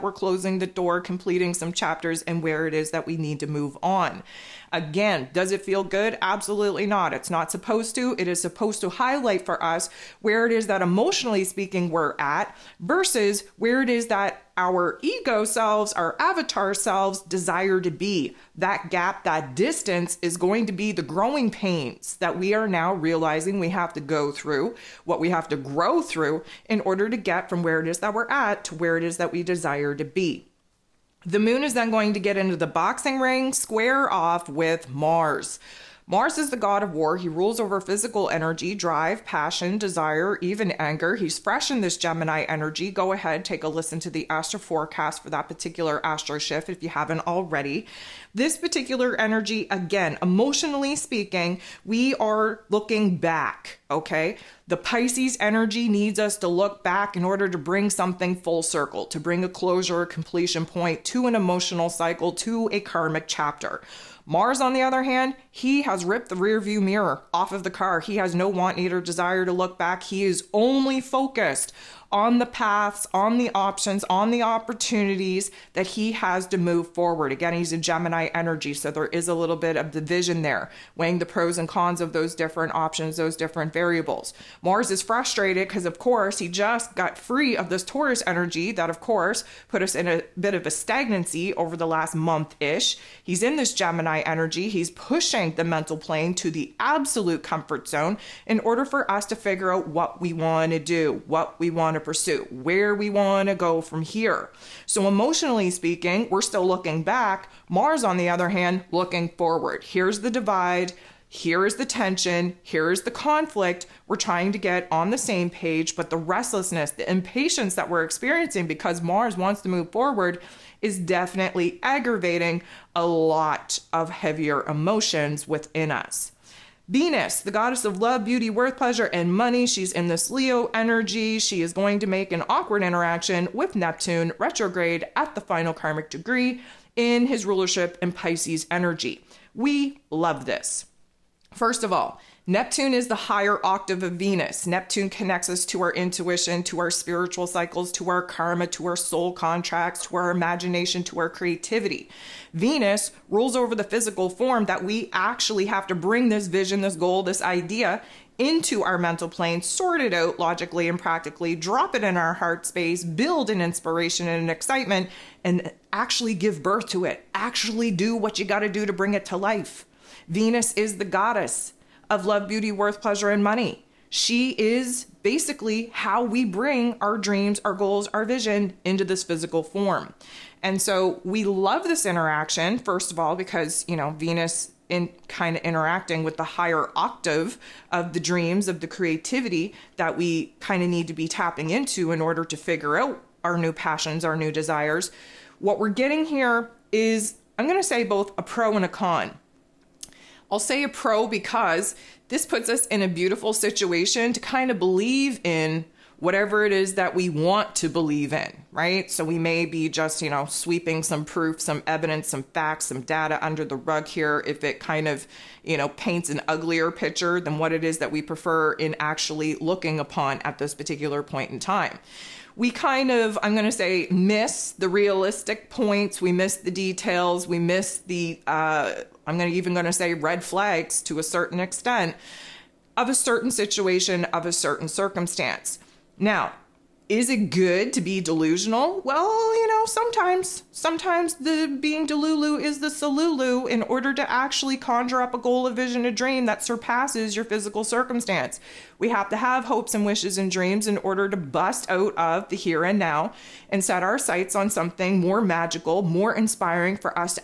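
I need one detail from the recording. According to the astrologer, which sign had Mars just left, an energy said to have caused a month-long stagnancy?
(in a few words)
Taurus.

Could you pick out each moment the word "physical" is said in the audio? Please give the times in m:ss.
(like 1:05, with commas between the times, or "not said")
0:37, 2:33, 2:59, 4:07.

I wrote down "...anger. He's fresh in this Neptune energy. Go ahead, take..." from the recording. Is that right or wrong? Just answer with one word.
wrong.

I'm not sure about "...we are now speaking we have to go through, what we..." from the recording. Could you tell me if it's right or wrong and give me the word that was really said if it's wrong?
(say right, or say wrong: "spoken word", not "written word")
wrong: "realizing", not "speaking".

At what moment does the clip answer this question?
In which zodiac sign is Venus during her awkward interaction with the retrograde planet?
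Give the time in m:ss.
2:10.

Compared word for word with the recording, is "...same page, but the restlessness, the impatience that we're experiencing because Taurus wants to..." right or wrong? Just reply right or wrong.
wrong.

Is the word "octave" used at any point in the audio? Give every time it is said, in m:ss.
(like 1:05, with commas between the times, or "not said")
2:23, 3:06.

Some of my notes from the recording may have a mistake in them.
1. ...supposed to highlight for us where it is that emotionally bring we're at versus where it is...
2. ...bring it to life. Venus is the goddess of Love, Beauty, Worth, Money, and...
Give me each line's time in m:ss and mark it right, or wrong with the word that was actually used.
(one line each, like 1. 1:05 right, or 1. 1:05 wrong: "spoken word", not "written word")
1. 0:08 wrong: "speaking", not "bring"
2. 2:48 wrong: "Pleasure", not "Money".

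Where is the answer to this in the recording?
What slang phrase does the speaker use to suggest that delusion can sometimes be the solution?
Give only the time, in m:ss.
4:02.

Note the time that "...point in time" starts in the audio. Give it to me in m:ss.
3:41.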